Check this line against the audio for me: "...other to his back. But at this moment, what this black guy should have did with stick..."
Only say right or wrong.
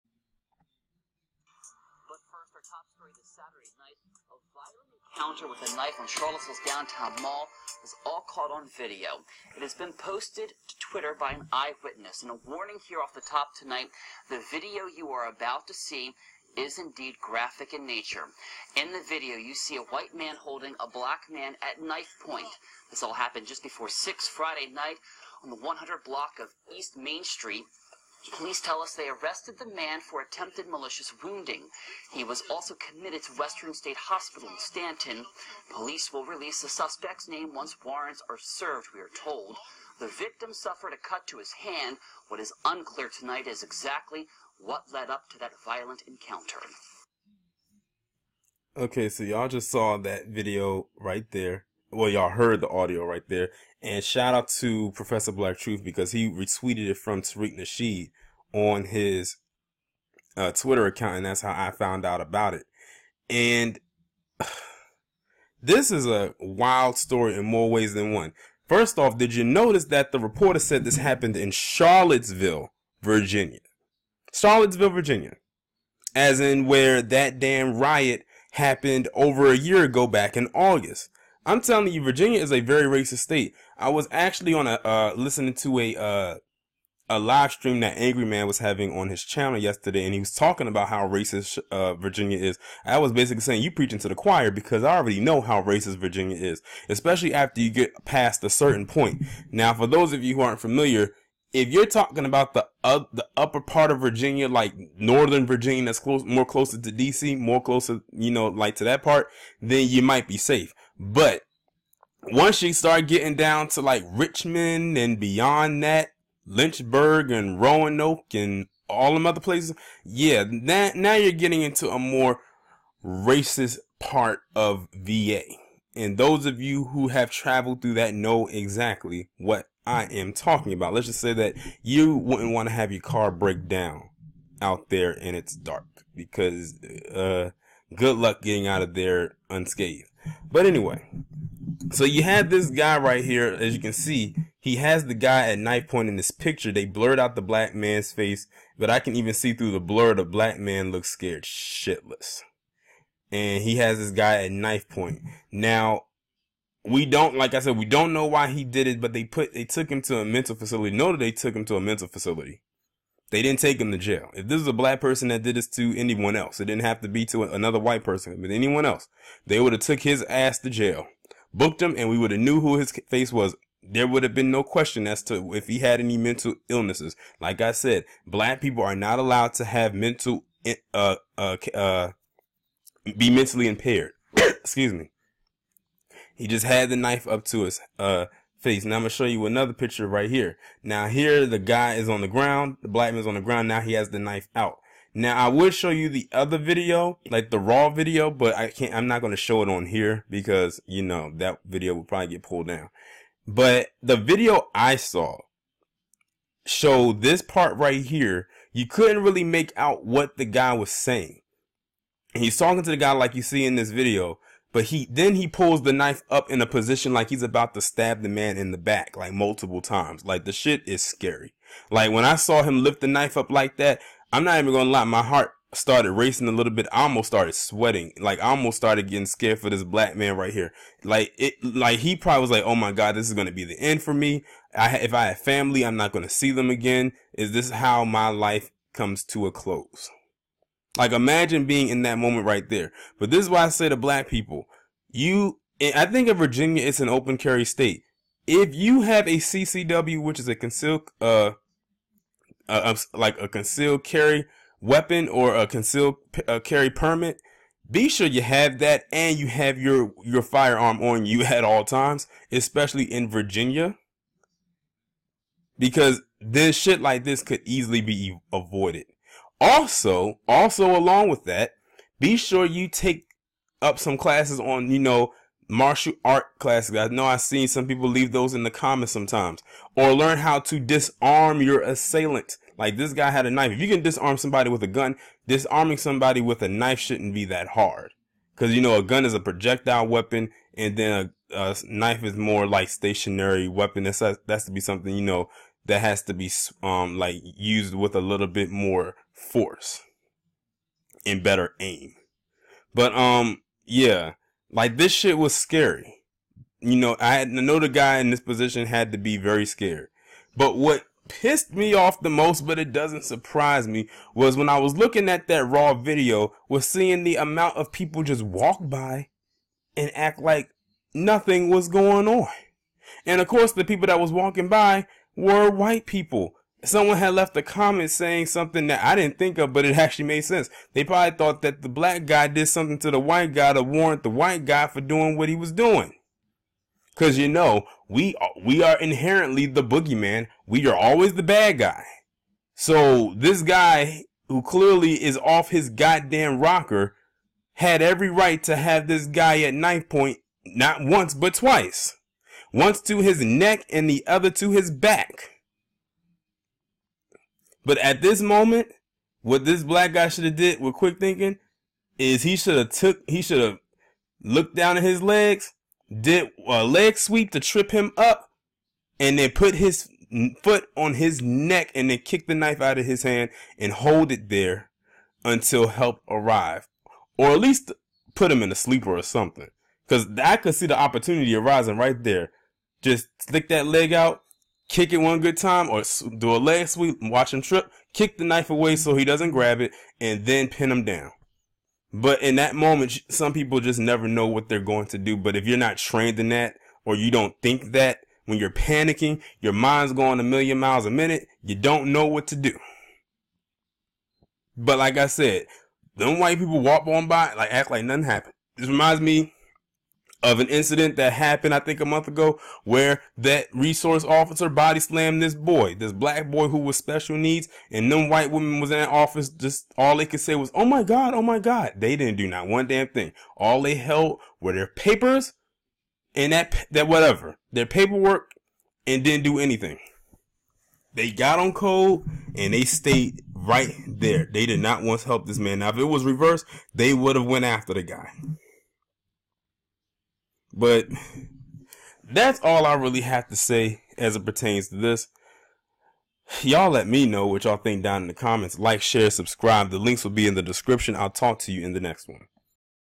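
wrong.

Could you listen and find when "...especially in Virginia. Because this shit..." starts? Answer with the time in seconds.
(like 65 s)
262 s.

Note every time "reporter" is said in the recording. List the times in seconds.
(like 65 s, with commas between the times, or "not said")
70 s.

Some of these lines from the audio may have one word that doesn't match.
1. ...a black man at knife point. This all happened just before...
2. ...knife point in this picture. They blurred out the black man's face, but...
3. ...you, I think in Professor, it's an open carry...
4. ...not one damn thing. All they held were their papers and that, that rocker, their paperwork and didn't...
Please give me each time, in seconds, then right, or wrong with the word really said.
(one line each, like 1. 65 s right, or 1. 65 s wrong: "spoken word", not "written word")
1. 20 s right
2. 145 s right
3. 245 s wrong: "Virginia", not "Professor"
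4. 422 s wrong: "whatever", not "rocker".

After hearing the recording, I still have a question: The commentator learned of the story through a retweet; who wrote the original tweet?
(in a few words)
Tariq Nasheed.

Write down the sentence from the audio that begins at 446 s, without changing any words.
Y'all let me know what y'all think down in the comments.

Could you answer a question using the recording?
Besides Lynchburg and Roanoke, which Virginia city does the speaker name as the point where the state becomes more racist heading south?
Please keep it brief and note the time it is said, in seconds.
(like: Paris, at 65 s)
Richmond, at 114 s.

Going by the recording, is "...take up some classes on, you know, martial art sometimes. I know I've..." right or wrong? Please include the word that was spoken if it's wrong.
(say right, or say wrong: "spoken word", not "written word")
wrong: "classes", not "sometimes".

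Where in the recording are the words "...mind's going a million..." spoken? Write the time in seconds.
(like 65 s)
399 s.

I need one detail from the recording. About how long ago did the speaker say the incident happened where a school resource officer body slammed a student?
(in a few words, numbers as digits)
A month ago.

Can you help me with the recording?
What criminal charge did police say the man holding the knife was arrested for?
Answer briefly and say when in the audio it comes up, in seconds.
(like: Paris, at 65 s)
Attempted malicious wounding, at 30 s.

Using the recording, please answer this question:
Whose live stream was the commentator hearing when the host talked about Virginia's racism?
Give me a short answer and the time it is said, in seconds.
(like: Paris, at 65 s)
Angry Man, at 87 s.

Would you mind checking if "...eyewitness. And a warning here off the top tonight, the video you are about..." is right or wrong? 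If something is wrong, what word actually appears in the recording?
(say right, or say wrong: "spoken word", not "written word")
right.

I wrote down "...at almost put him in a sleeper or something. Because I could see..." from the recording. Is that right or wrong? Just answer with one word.
wrong.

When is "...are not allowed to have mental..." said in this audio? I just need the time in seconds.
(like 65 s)
178 s.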